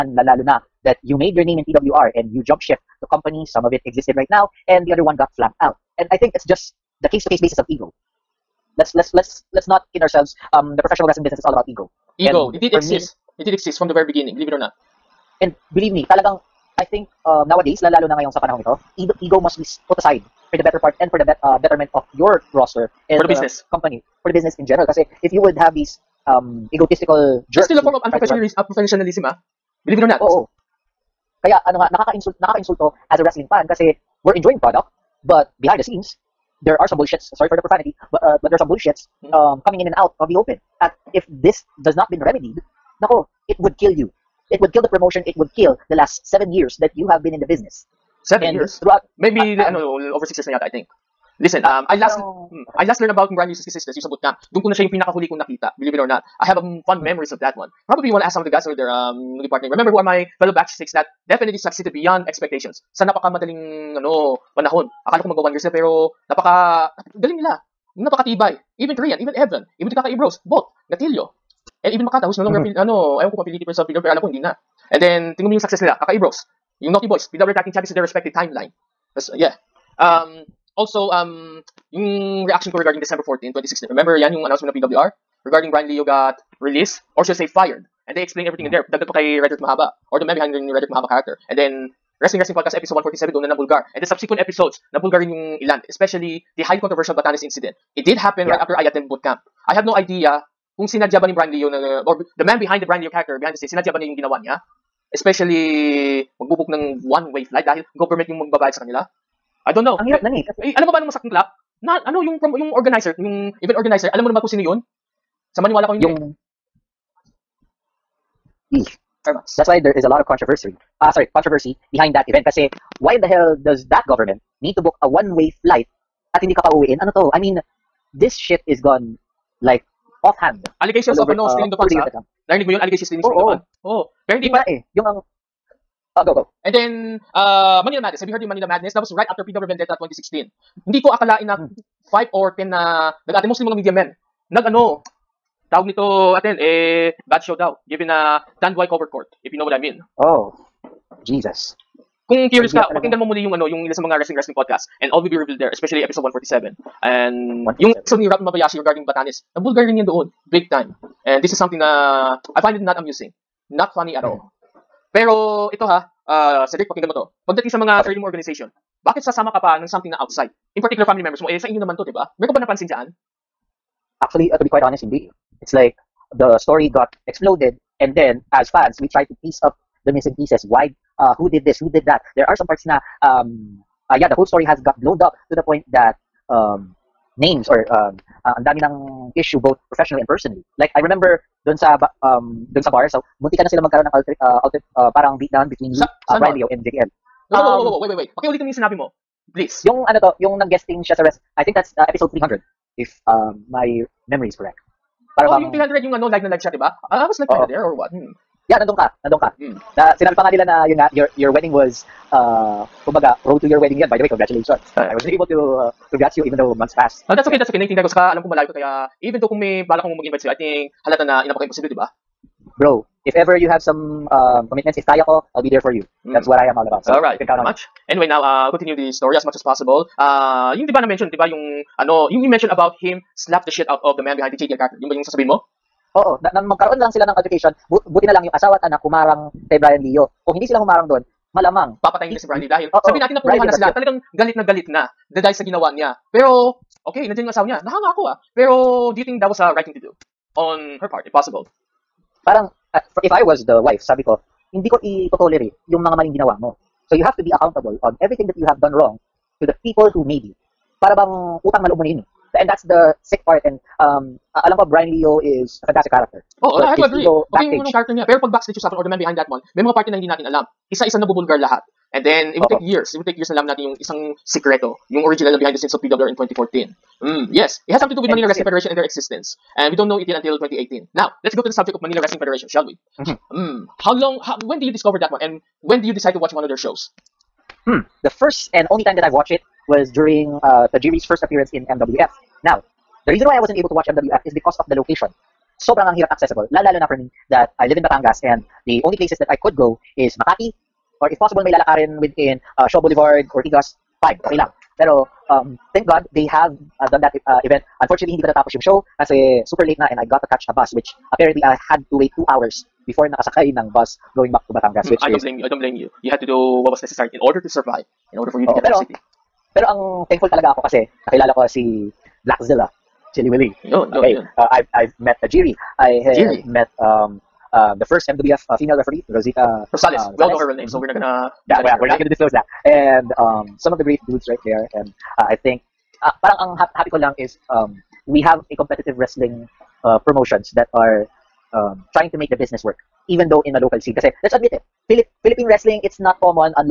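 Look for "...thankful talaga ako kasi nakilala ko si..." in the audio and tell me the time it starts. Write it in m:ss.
5:20.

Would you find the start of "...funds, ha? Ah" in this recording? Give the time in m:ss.
2:11.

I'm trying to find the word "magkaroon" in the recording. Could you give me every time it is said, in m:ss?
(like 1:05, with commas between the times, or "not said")
3:13, 3:56.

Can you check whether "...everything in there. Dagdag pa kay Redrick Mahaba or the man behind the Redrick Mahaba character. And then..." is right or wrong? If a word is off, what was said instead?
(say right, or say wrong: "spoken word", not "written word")
right.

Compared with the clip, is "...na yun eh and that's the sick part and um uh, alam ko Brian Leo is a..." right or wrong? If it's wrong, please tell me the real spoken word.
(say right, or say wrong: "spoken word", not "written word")
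right.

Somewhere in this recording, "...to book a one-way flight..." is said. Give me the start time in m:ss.
2:04.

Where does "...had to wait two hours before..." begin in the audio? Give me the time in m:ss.
5:11.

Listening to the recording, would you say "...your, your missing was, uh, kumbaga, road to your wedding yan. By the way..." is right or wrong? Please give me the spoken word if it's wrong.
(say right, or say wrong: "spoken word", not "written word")
wrong: "wedding", not "missing".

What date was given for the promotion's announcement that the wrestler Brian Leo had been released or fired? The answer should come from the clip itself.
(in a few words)
December 14, 2016.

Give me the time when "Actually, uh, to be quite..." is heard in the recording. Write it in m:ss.
2:54.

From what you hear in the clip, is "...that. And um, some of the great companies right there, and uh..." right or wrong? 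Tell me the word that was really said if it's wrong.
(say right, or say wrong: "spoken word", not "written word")
wrong: "dudes", not "companies".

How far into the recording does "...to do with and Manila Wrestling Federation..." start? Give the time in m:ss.
4:38.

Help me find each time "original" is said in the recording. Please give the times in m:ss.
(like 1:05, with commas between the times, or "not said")
4:35.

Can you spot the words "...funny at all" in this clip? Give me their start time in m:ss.
2:43.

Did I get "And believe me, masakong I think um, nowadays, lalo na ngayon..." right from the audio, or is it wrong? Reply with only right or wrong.
wrong.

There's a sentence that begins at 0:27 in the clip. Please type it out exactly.
It's still a form of unprofessionalism, unprofessionalism ah.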